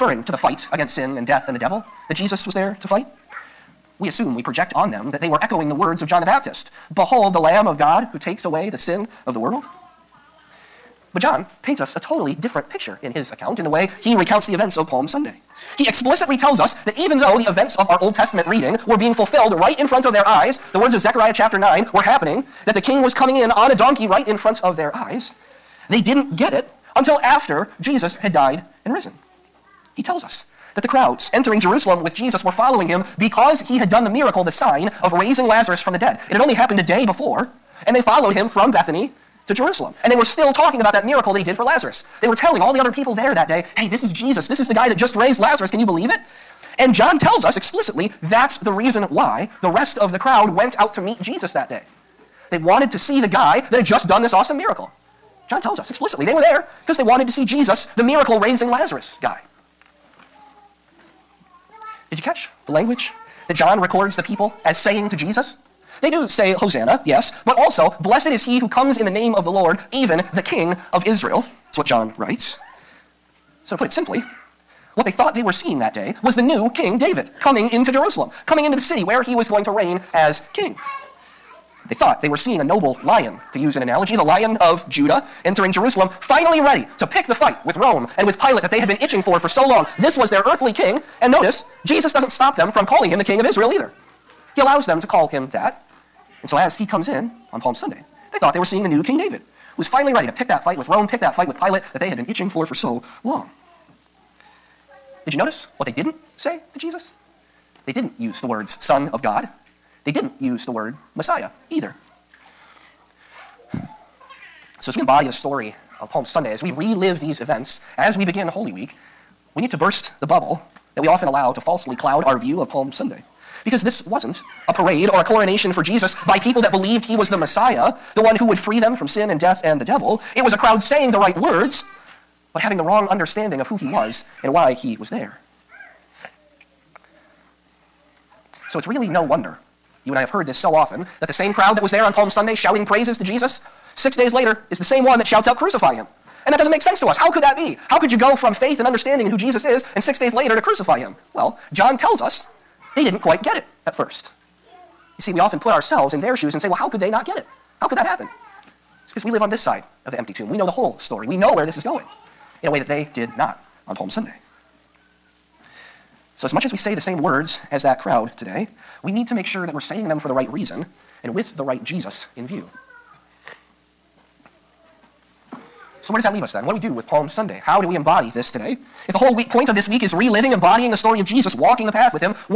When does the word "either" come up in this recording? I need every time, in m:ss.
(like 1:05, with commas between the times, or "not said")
1:33, 1:51.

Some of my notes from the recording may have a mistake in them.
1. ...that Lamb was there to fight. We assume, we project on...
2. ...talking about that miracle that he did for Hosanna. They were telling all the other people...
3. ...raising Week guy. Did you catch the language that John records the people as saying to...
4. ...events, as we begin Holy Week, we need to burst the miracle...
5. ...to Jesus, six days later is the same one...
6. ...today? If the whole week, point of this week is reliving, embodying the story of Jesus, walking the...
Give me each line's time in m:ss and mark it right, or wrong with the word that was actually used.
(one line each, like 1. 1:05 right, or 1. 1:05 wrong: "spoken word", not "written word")
1. 0:02 wrong: "Jesus", not "Lamb"
2. 0:40 wrong: "Lazarus", not "Hosanna"
3. 0:58 wrong: "Lazarus", not "Week"
4. 1:57 wrong: "bubble", not "miracle"
5. 2:23 right
6. 2:58 right.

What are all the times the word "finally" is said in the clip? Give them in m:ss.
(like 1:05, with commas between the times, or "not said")
1:26, 1:39.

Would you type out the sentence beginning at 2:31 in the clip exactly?
Well, John tells us they didn't quite get it at first.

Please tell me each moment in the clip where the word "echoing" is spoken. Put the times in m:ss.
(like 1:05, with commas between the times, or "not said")
0:05.